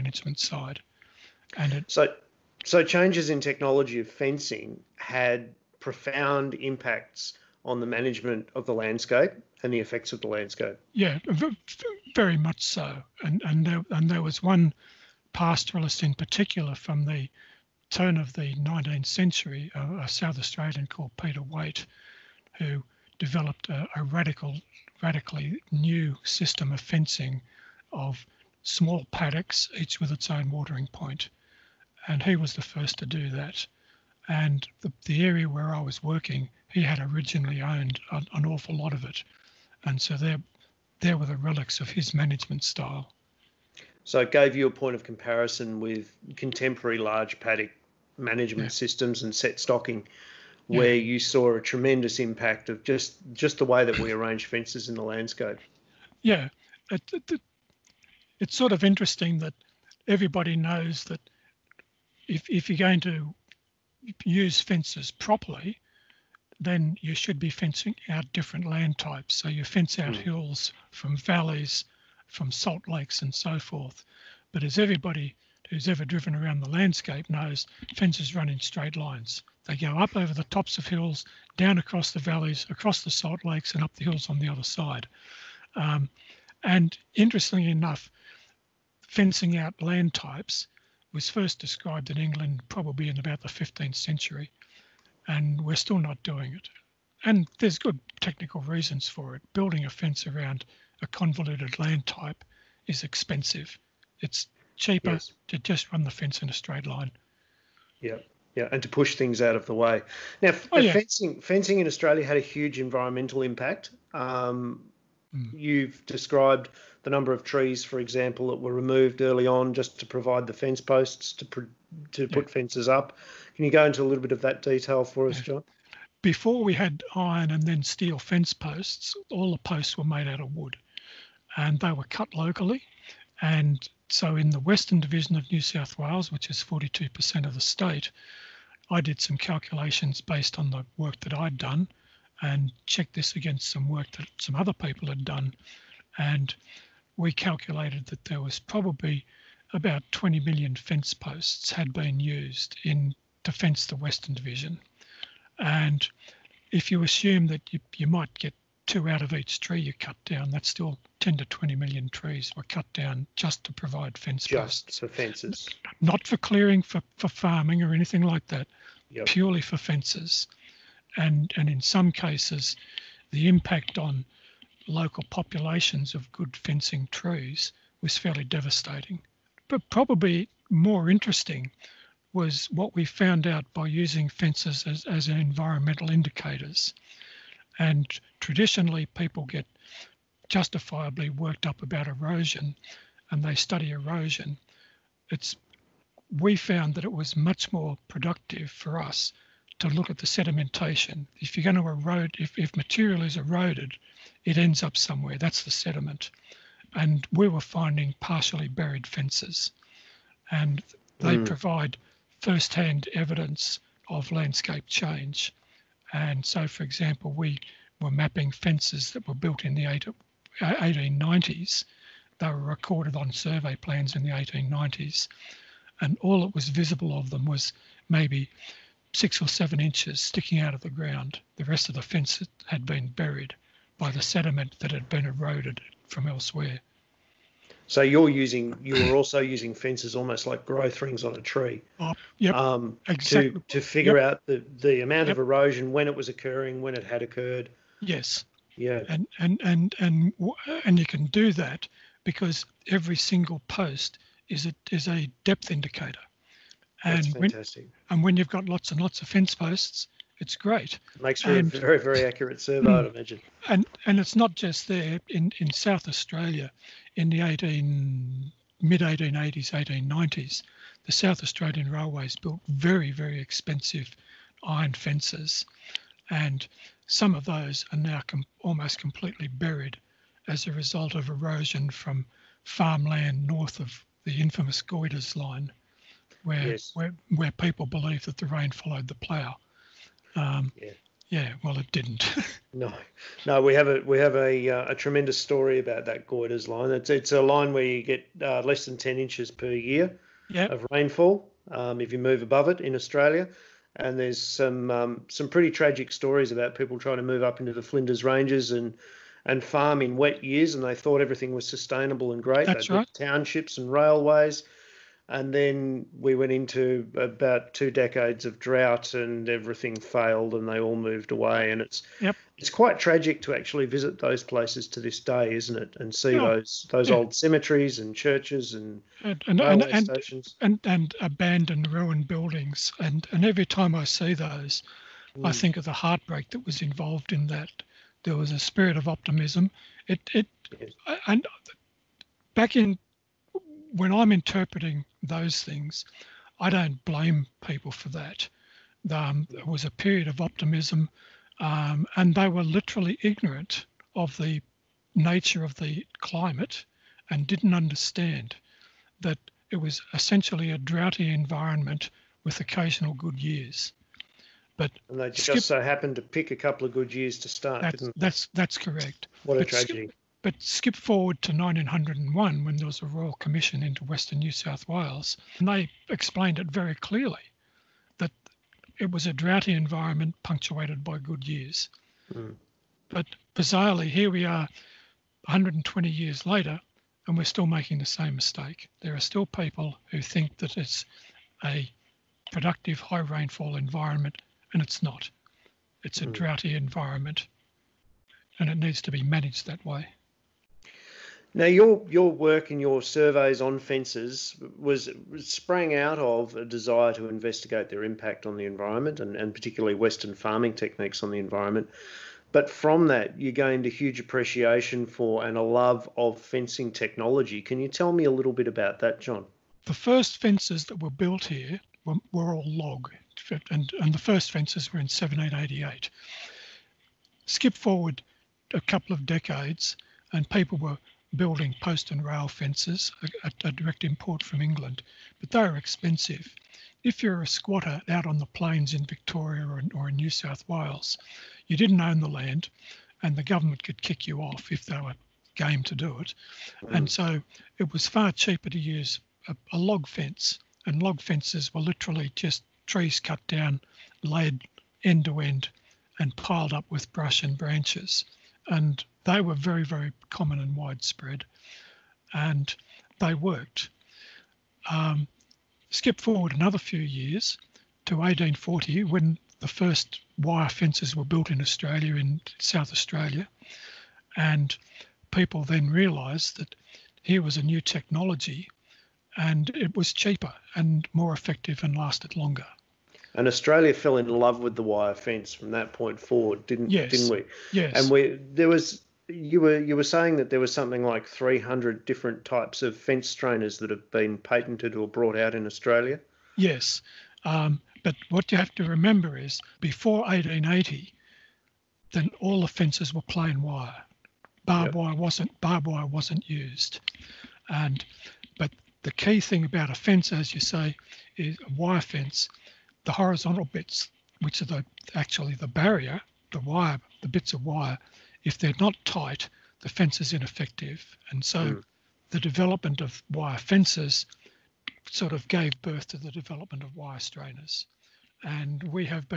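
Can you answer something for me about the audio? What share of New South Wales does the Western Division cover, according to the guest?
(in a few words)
42%.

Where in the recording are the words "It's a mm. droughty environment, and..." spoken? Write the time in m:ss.
6:36.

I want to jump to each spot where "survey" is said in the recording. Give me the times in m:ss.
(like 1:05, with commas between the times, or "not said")
3:43, 4:22, 6:42.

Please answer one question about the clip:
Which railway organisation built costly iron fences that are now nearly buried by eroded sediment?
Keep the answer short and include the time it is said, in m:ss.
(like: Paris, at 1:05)
South Australian Railways, at 4:31.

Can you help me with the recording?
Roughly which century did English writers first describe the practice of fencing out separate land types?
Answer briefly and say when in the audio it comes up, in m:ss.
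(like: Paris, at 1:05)
15th century, at 1:33.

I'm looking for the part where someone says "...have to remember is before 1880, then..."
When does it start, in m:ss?
8:18.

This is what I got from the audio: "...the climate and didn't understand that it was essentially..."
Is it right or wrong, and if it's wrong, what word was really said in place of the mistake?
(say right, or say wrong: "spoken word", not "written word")
right.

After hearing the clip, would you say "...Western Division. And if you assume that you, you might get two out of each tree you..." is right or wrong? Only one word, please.
right.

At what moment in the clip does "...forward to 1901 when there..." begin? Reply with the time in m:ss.
6:10.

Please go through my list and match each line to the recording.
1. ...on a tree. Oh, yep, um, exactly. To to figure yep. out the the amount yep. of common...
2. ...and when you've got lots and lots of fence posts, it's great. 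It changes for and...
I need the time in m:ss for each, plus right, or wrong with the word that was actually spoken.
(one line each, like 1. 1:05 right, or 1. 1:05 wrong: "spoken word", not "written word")
1. 4:01 wrong: "erosion", not "common"
2. 4:18 wrong: "makes", not "changes".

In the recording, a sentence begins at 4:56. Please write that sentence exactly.
It's it's a line where you get uh, less than ten inches per year yep.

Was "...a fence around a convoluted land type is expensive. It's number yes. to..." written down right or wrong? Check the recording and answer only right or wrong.
wrong.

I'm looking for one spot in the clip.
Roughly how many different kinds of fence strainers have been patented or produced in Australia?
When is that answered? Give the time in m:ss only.
8:11.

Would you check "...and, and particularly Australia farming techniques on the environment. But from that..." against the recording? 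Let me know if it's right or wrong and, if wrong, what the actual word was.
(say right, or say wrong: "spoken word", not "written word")
wrong: "Western", not "Australia".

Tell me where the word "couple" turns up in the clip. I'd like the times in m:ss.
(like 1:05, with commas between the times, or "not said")
6:06, 7:08.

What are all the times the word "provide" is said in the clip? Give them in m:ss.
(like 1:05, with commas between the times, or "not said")
2:00, 2:43, 3:31.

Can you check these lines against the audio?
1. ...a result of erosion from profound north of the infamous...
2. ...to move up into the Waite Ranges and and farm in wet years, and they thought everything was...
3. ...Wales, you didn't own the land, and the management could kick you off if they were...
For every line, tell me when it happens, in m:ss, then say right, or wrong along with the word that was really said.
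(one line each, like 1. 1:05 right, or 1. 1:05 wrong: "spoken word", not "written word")
1. 4:40 wrong: "farmland", not "profound"
2. 5:07 wrong: "Flinders", not "Waite"
3. 7:20 wrong: "government", not "management".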